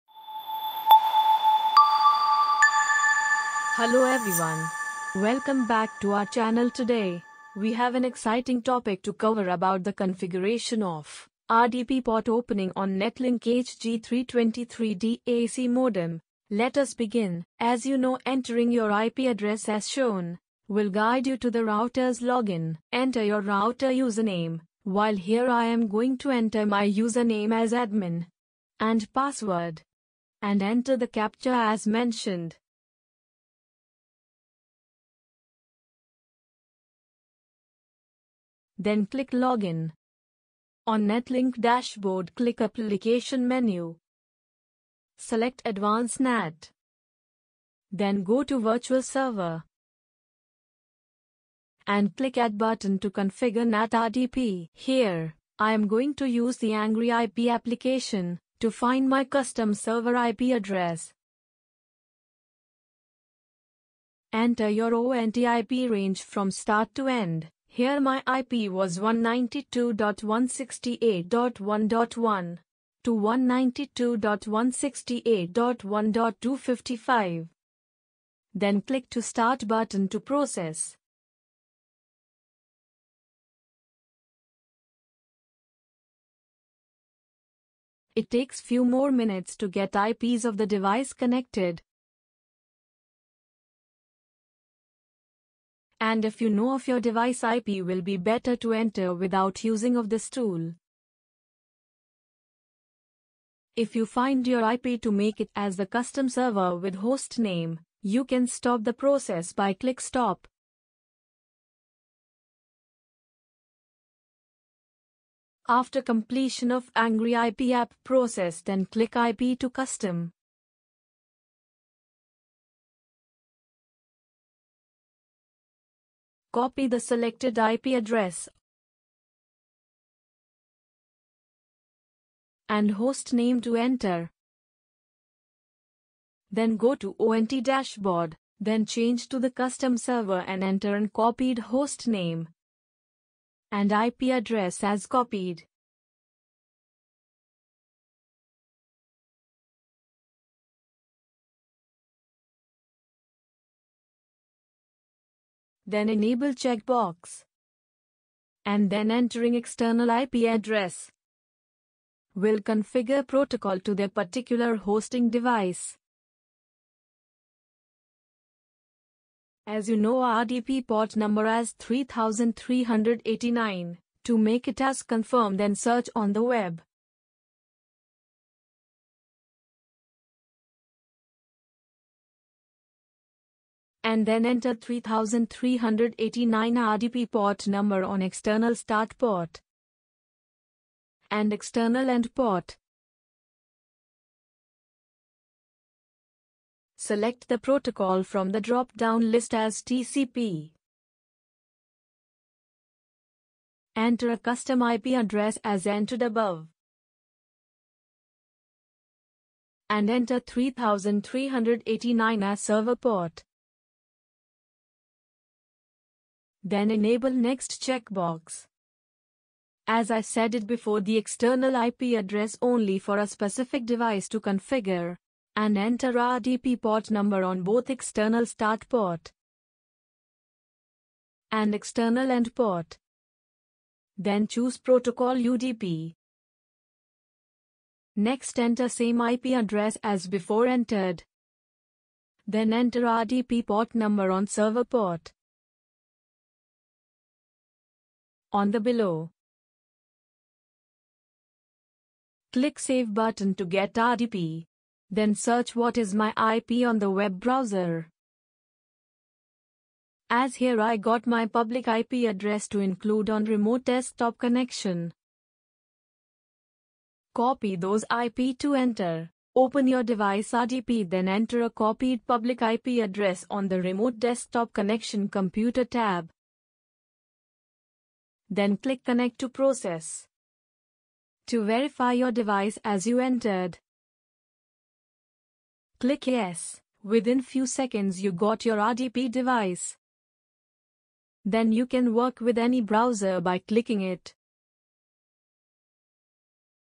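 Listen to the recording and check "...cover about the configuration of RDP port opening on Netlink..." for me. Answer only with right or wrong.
right.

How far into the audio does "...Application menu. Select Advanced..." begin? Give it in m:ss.
0:42.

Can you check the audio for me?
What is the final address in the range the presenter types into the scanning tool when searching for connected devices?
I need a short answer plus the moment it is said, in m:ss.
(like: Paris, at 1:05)
192.168.1.255, at 1:13.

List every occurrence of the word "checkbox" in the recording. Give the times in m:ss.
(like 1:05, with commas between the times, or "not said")
2:36, 3:37.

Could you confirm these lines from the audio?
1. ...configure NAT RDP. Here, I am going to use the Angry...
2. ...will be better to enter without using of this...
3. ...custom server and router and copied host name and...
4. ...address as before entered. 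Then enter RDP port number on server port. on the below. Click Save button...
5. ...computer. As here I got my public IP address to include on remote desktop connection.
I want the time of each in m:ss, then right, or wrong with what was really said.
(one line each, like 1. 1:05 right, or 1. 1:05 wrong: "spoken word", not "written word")
1. 0:53 right
2. 1:37 right
3. 2:19 wrong: "enter", not "router"
4. 3:59 right
5. 4:17 wrong: "browser", not "computer".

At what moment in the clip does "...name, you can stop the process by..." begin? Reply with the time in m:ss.
1:47.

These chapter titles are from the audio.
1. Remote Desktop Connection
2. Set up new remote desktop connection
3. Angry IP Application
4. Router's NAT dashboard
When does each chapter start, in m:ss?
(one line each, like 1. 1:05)
1. 4:30
2. 2:18
3. 0:54
4. 0:18.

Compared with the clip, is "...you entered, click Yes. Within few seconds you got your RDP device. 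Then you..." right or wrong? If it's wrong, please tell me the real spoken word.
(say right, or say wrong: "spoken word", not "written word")
right.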